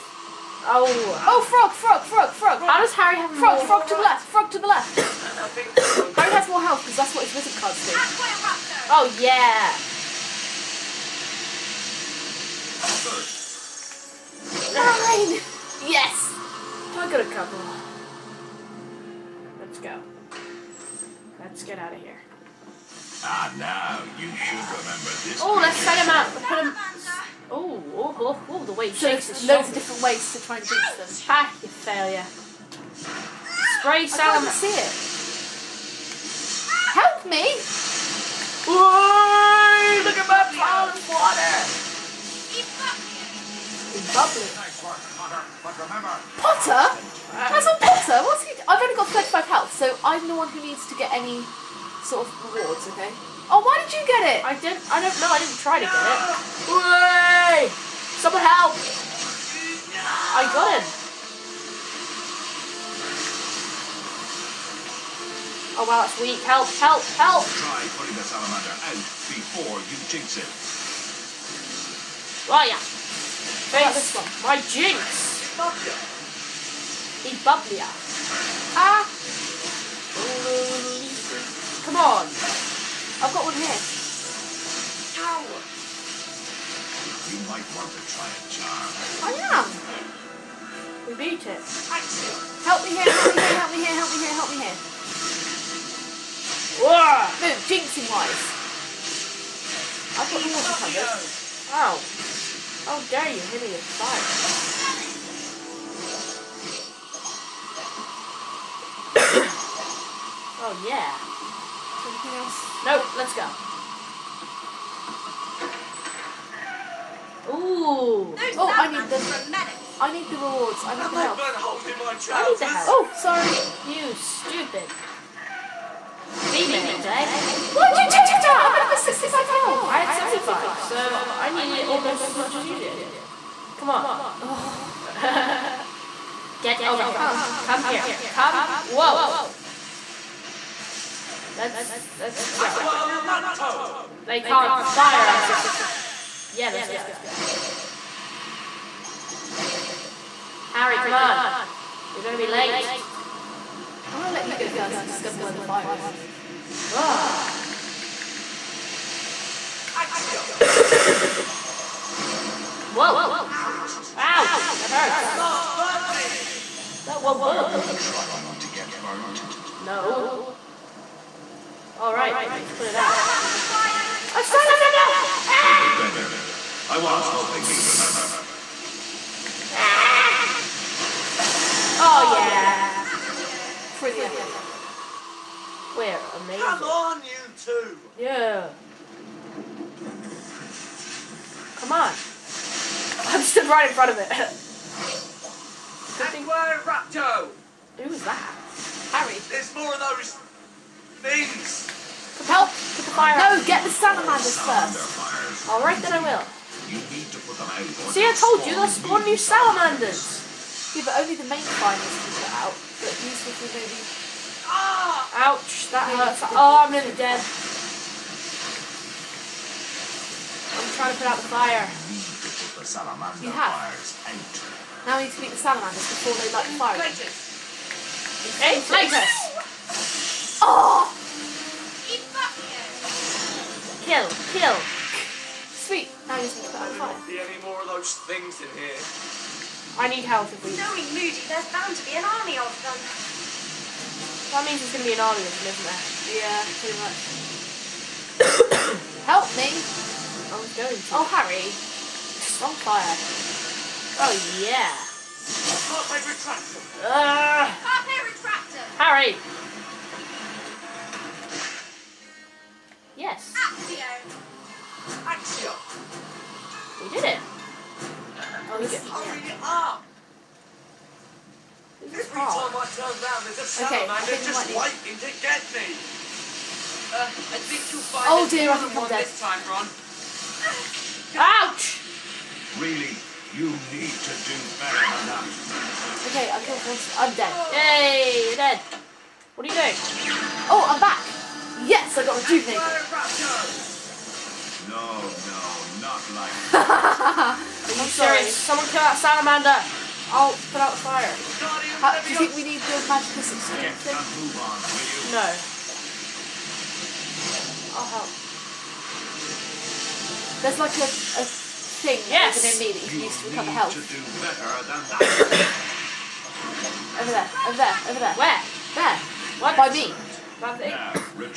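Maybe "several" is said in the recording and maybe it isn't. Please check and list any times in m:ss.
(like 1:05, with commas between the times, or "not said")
not said.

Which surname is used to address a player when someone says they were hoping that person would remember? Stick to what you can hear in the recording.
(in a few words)
Granger.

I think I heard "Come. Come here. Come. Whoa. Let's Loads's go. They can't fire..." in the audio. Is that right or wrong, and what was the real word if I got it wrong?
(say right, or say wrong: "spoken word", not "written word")
wrong: "Let", not "Loads".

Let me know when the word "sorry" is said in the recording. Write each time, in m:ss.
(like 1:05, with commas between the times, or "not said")
2:03, 4:58.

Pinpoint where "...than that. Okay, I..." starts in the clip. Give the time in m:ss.
4:45.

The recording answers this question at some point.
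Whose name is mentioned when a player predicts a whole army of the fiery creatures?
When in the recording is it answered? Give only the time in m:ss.
4:01.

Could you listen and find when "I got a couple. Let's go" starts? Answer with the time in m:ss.
0:16.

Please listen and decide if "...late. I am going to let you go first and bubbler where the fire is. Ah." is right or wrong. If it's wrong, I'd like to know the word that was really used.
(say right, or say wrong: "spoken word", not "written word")
wrong: "discover", not "bubbler".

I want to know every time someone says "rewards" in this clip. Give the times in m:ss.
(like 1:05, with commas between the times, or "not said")
0:52, 2:00.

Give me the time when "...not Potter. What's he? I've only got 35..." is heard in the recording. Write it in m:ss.
0:47.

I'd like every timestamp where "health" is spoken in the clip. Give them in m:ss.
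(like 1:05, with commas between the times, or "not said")
0:06, 0:49, 2:09, 5:13.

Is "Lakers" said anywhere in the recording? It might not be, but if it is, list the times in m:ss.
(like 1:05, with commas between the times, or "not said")
3:48.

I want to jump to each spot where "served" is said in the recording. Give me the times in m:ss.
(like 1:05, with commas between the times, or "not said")
not said.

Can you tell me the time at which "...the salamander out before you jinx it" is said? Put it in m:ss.
1:08.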